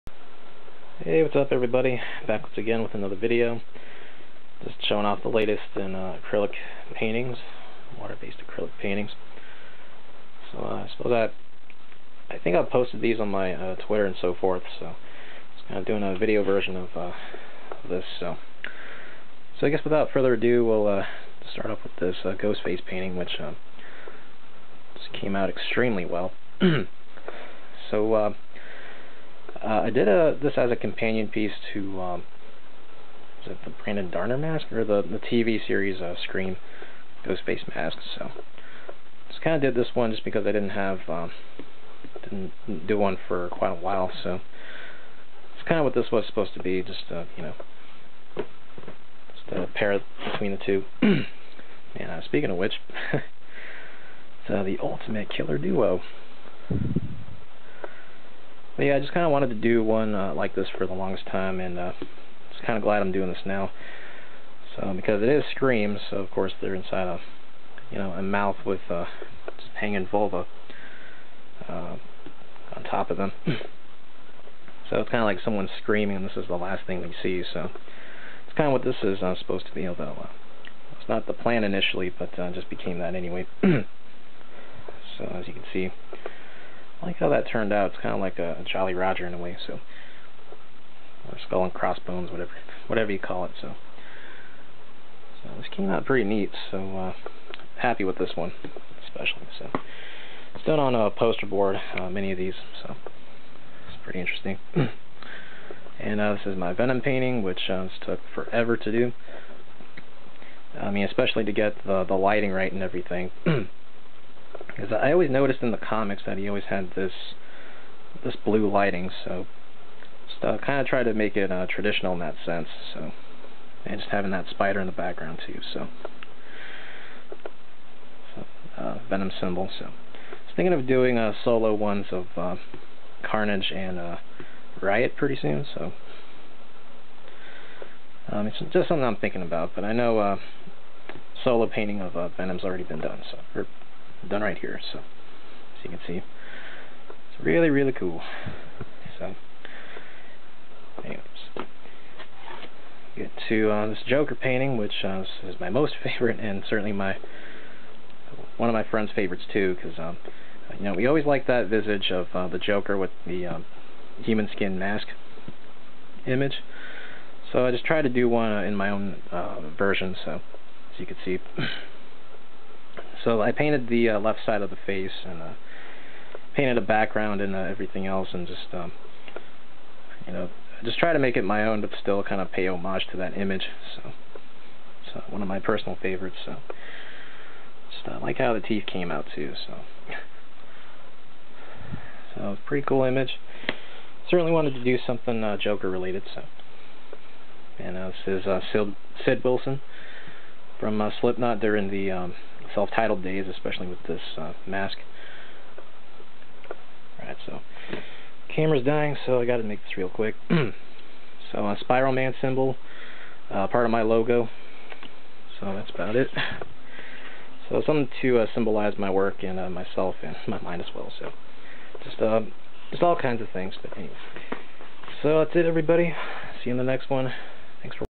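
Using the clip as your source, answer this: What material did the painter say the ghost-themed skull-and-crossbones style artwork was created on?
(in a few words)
Poster board.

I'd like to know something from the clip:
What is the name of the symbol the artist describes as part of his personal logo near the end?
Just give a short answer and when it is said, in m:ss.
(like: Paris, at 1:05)
Spiral Man, at 3:31.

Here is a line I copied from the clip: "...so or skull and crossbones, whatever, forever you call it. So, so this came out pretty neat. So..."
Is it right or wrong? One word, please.
wrong.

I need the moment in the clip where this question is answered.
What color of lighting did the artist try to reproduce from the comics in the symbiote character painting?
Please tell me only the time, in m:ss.
1:58.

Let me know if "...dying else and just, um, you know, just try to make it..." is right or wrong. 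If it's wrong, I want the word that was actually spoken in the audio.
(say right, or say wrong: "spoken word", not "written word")
wrong: "everything", not "dying".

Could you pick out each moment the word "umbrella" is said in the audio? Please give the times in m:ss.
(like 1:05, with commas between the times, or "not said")
not said.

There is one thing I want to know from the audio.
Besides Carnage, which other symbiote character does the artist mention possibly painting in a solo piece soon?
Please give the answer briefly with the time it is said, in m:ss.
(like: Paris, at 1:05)
Riot, at 2:14.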